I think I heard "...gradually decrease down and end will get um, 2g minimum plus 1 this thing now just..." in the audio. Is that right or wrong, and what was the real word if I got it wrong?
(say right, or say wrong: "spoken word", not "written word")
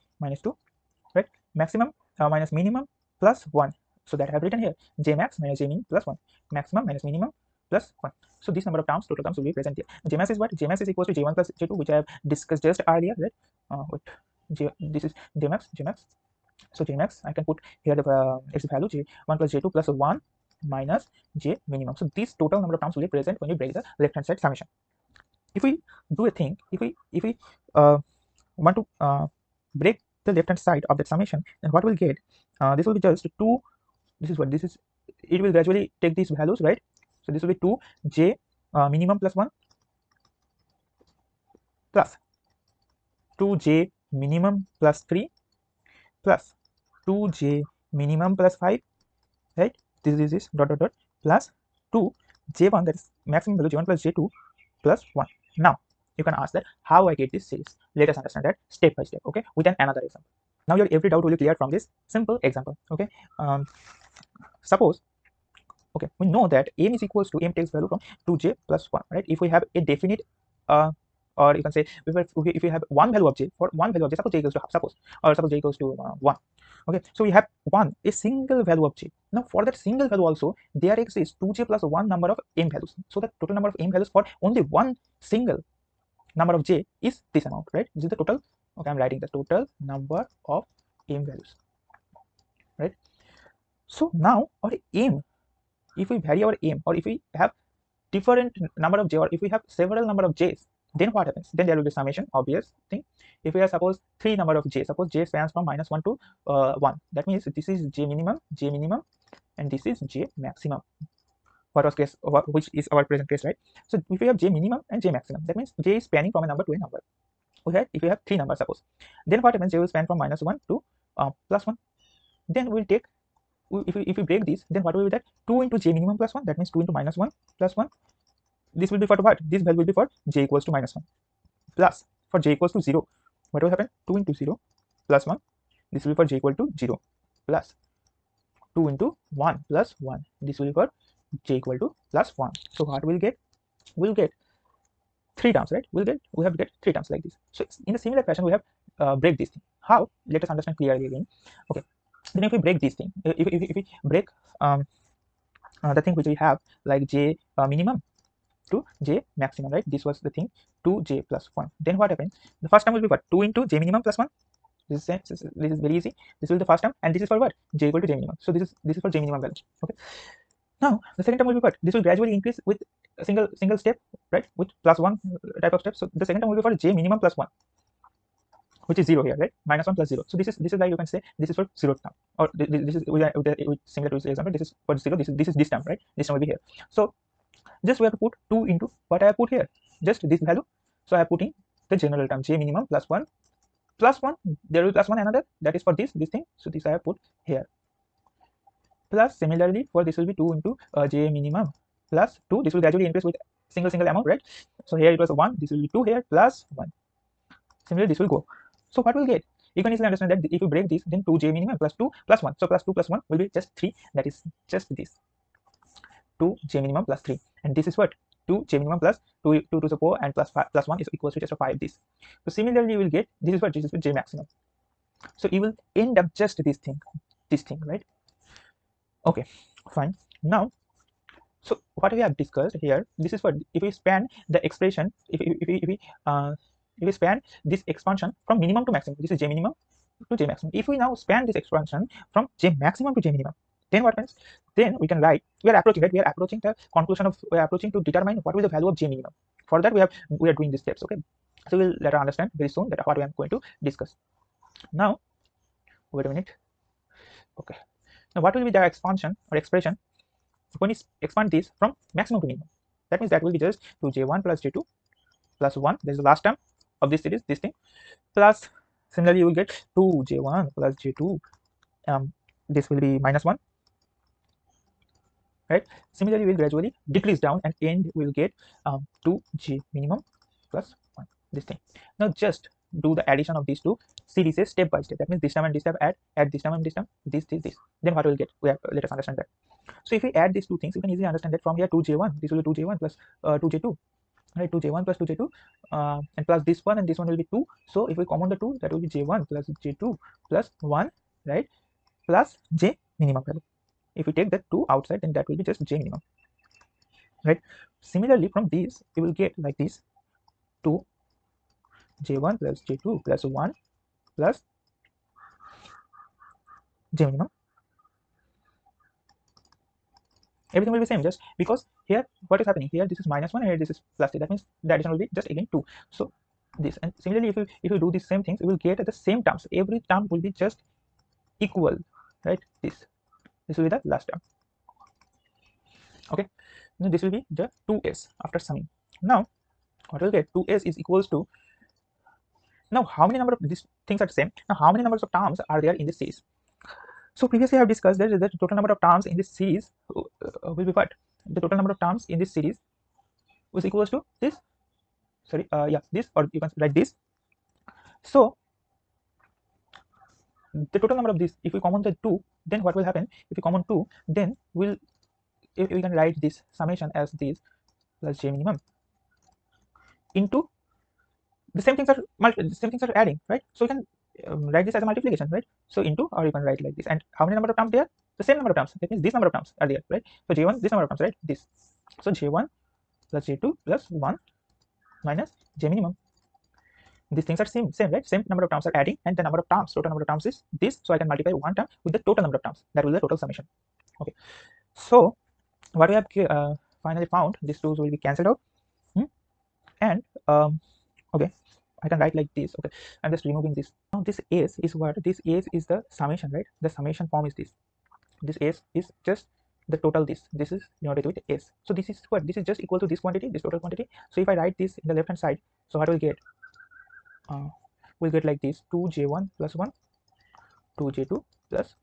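right.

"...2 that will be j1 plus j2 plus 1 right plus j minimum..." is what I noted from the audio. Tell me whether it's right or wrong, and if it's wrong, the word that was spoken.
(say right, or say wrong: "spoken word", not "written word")
right.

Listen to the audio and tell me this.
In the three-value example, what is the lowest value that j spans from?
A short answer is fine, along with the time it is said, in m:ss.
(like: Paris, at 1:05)
minus 1, at 1:45.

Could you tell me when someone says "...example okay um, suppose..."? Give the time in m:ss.
1:02.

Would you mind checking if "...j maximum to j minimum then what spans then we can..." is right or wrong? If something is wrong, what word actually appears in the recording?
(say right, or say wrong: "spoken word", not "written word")
wrong: "happens", not "spans".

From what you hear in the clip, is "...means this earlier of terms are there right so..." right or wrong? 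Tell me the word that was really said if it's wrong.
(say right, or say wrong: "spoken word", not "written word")
wrong: "number", not "earlier".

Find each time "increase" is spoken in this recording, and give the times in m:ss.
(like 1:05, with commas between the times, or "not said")
2:52, 3:23.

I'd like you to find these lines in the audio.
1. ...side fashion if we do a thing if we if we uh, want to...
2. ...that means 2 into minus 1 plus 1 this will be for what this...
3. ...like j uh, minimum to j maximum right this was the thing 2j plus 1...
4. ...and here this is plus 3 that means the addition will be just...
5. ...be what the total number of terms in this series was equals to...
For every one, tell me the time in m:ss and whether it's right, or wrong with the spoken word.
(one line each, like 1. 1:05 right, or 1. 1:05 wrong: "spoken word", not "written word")
1. 0:24 wrong: "summation", not "fashion"
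2. 2:06 right
3. 2:36 right
4. 5:23 right
5. 5:50 right.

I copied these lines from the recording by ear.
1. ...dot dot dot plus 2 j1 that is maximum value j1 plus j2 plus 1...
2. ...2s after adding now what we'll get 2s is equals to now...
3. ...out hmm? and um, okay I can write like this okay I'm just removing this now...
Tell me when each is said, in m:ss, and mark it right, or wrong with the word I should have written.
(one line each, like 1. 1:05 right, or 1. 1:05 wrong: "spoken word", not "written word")
1. 0:50 right
2. 5:37 wrong: "summing", not "adding"
3. 6:38 right.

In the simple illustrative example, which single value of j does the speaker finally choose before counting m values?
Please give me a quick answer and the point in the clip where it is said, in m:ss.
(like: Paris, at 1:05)
1, at 1:15.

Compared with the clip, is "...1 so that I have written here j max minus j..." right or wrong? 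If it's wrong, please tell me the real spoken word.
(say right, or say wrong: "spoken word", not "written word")
right.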